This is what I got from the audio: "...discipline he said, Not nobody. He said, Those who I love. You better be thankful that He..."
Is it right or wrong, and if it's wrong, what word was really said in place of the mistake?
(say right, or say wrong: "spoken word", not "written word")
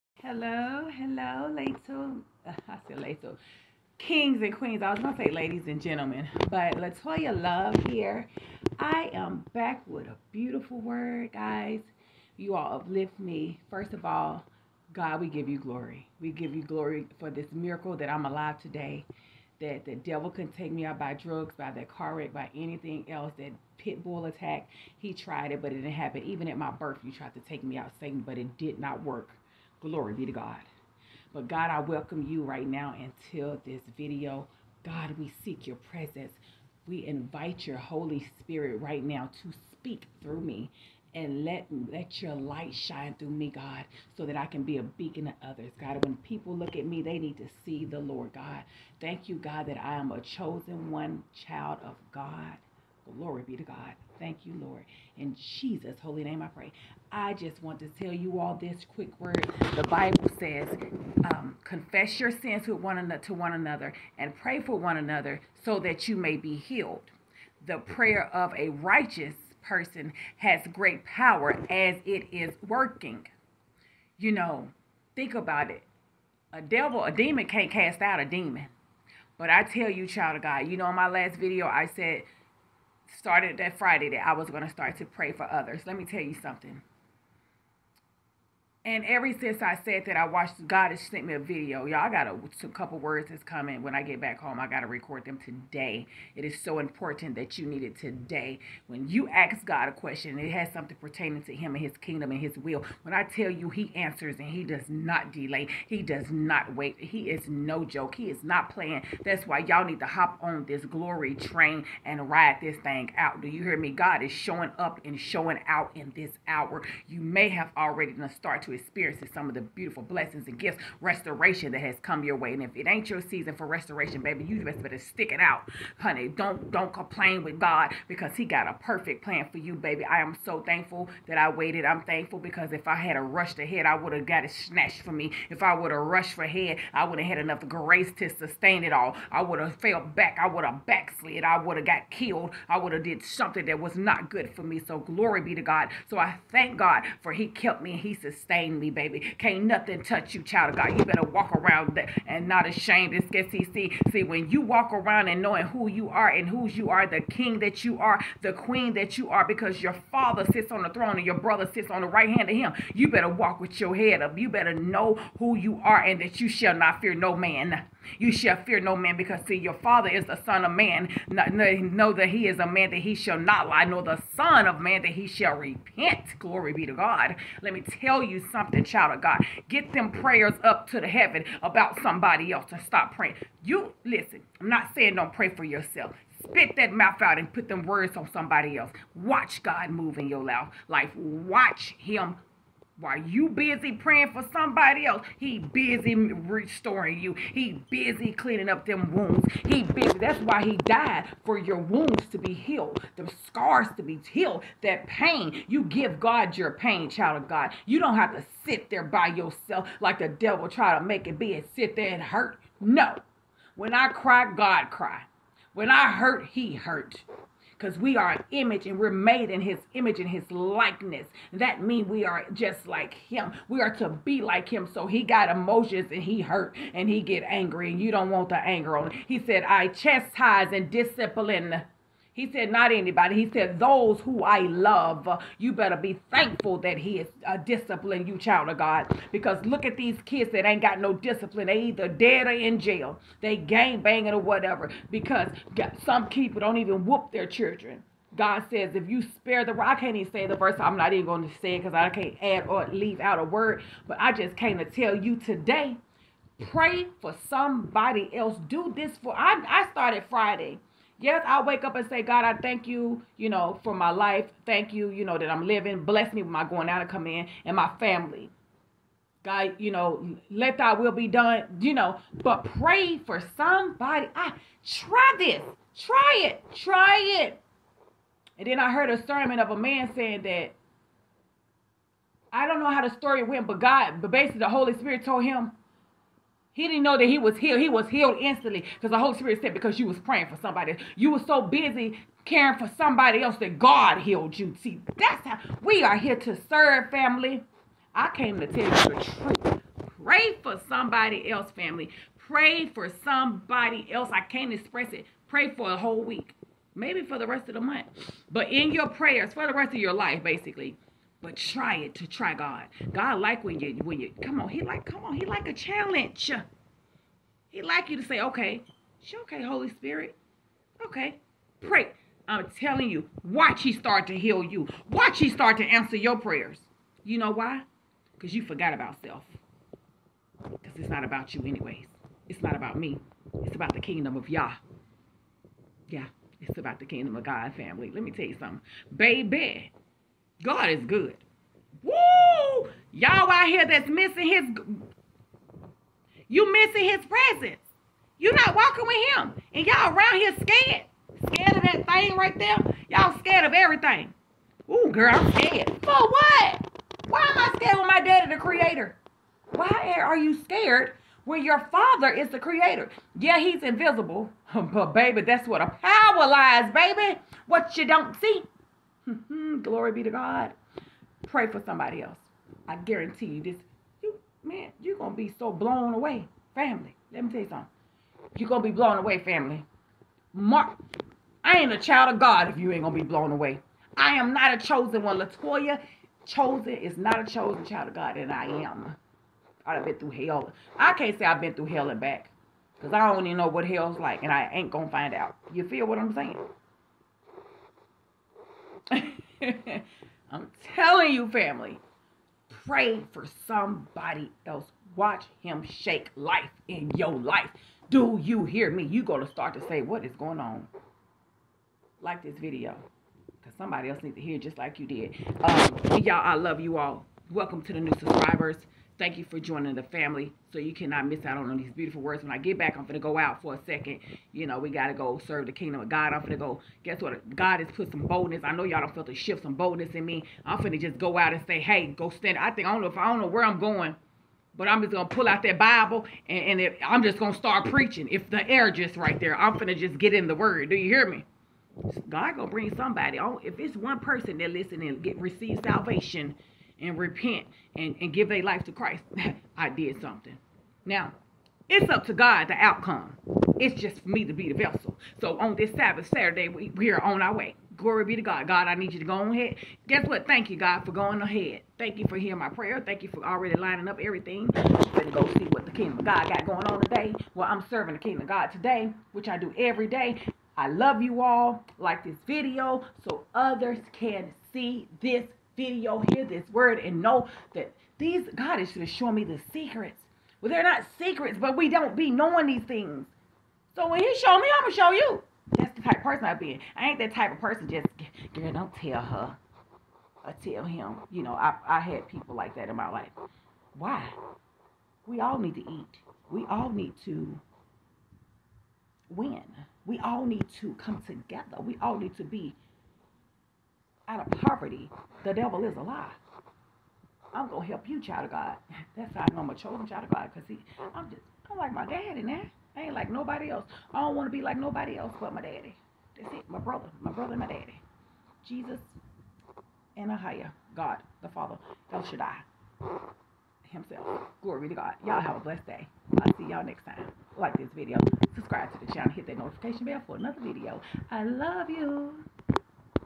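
wrong: "anybody", not "nobody".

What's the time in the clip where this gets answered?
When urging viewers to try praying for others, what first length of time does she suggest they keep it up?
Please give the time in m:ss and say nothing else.
5:05.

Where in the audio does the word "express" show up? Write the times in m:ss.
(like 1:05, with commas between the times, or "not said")
5:04.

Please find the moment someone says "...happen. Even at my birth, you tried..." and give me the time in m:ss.
0:25.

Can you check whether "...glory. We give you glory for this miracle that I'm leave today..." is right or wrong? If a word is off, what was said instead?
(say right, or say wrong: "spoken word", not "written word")
wrong: "alive", not "leave".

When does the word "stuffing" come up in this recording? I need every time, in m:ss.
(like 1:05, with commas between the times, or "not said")
not said.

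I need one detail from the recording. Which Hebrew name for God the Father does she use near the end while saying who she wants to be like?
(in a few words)
El Shaddai.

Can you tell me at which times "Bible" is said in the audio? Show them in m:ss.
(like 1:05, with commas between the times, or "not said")
0:59, 7:15.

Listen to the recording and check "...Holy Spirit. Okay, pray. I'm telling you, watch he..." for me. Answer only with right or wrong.
right.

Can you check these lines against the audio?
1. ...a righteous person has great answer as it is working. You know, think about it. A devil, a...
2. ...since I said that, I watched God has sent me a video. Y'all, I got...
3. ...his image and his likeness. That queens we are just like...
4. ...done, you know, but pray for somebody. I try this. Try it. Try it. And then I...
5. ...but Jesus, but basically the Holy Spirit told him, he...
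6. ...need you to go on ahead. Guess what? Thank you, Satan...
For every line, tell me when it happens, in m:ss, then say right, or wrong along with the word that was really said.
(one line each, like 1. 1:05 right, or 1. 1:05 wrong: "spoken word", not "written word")
1. 1:08 wrong: "power", not "answer"
2. 1:29 right
3. 3:39 wrong: "means", not "queens"
4. 4:31 right
5. 4:43 wrong: "God", not "Jesus"
6. 7:38 wrong: "God", not "Satan".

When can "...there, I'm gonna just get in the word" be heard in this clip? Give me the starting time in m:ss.
7:19.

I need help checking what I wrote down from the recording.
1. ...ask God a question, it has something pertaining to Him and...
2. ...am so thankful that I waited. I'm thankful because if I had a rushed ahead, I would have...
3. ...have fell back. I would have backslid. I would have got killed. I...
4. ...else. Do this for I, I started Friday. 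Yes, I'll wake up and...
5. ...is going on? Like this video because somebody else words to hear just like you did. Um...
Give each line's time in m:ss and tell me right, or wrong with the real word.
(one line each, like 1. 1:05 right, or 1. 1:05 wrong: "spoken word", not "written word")
1. 1:39 right
2. 2:10 right
3. 2:19 right
4. 4:18 right
5. 6:50 wrong: "needs", not "words".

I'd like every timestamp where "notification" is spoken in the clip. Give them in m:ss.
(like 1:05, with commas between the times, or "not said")
8:49.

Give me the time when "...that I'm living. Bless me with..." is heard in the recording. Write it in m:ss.
4:25.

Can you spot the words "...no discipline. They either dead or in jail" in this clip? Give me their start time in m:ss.
4:00.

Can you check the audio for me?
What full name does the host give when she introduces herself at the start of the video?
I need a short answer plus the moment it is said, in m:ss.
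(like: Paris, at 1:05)
Latoya Love, at 0:06.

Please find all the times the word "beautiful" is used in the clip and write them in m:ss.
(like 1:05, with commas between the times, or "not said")
0:10, 1:59, 7:01.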